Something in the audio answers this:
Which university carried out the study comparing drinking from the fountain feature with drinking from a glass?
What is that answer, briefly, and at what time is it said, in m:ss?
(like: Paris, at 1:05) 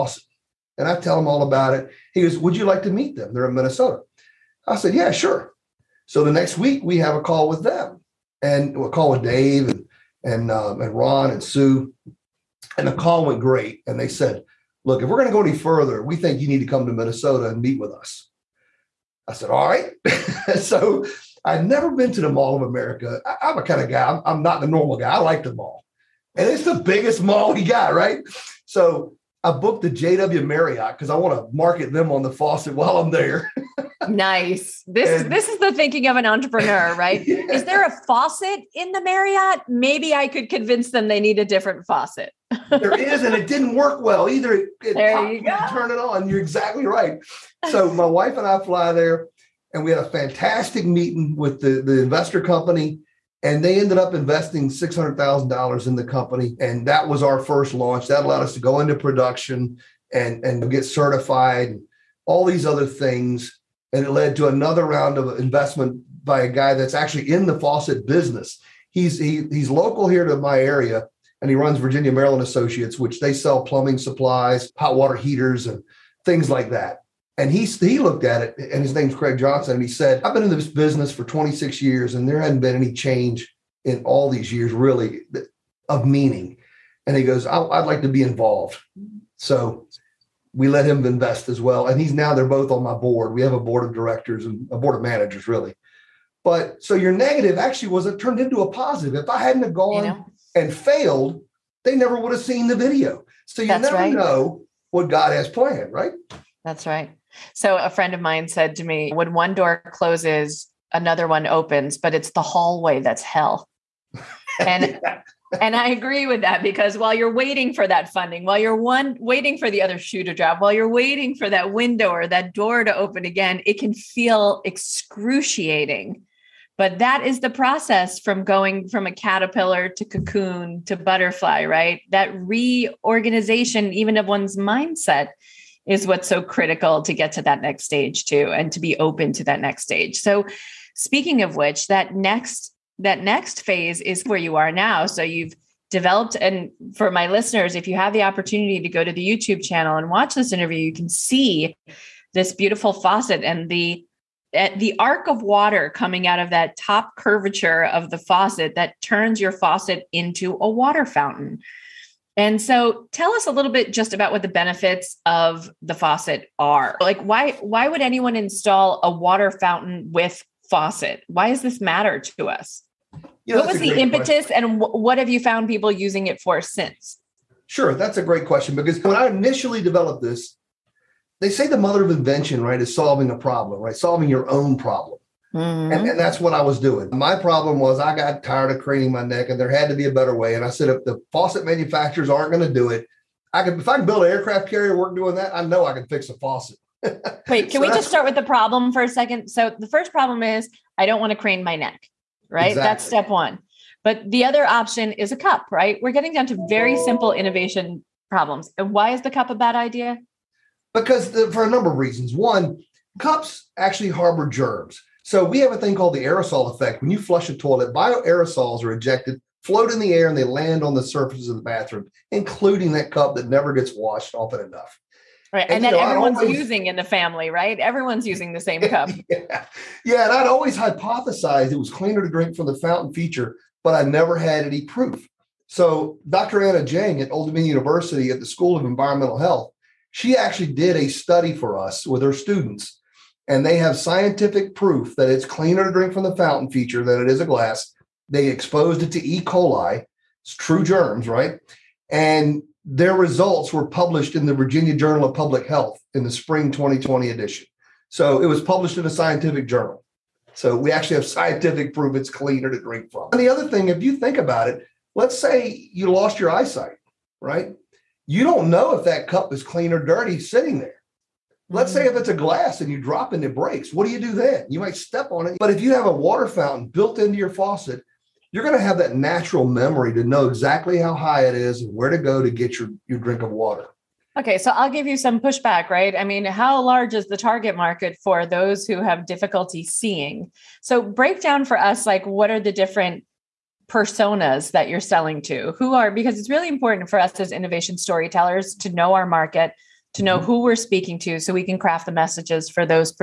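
Old Dominion University, at 3:57.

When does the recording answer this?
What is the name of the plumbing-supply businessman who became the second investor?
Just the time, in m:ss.
1:19.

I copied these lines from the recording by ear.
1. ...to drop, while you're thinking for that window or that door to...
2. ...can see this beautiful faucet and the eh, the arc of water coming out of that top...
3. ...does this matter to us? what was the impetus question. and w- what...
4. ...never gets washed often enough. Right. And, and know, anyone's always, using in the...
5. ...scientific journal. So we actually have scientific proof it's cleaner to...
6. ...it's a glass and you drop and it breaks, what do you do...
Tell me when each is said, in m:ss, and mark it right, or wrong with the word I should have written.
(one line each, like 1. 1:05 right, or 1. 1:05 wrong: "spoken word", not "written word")
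1. 2:00 wrong: "waiting", not "thinking"
2. 2:30 right
3. 2:51 right
4. 3:43 wrong: "everyone", not "anyone"
5. 4:19 right
6. 4:32 right.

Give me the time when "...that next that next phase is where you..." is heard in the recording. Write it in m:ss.
2:21.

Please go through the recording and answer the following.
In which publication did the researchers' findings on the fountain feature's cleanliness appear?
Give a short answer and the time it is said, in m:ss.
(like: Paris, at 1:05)
Virginia Journal of Public Health, at 4:14.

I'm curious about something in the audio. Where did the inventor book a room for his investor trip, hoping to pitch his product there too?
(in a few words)
JW Marriott.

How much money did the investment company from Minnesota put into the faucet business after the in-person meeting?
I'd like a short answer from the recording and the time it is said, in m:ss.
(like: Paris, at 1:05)
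$600,000, at 0:54.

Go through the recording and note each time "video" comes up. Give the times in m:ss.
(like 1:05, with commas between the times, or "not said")
1:42.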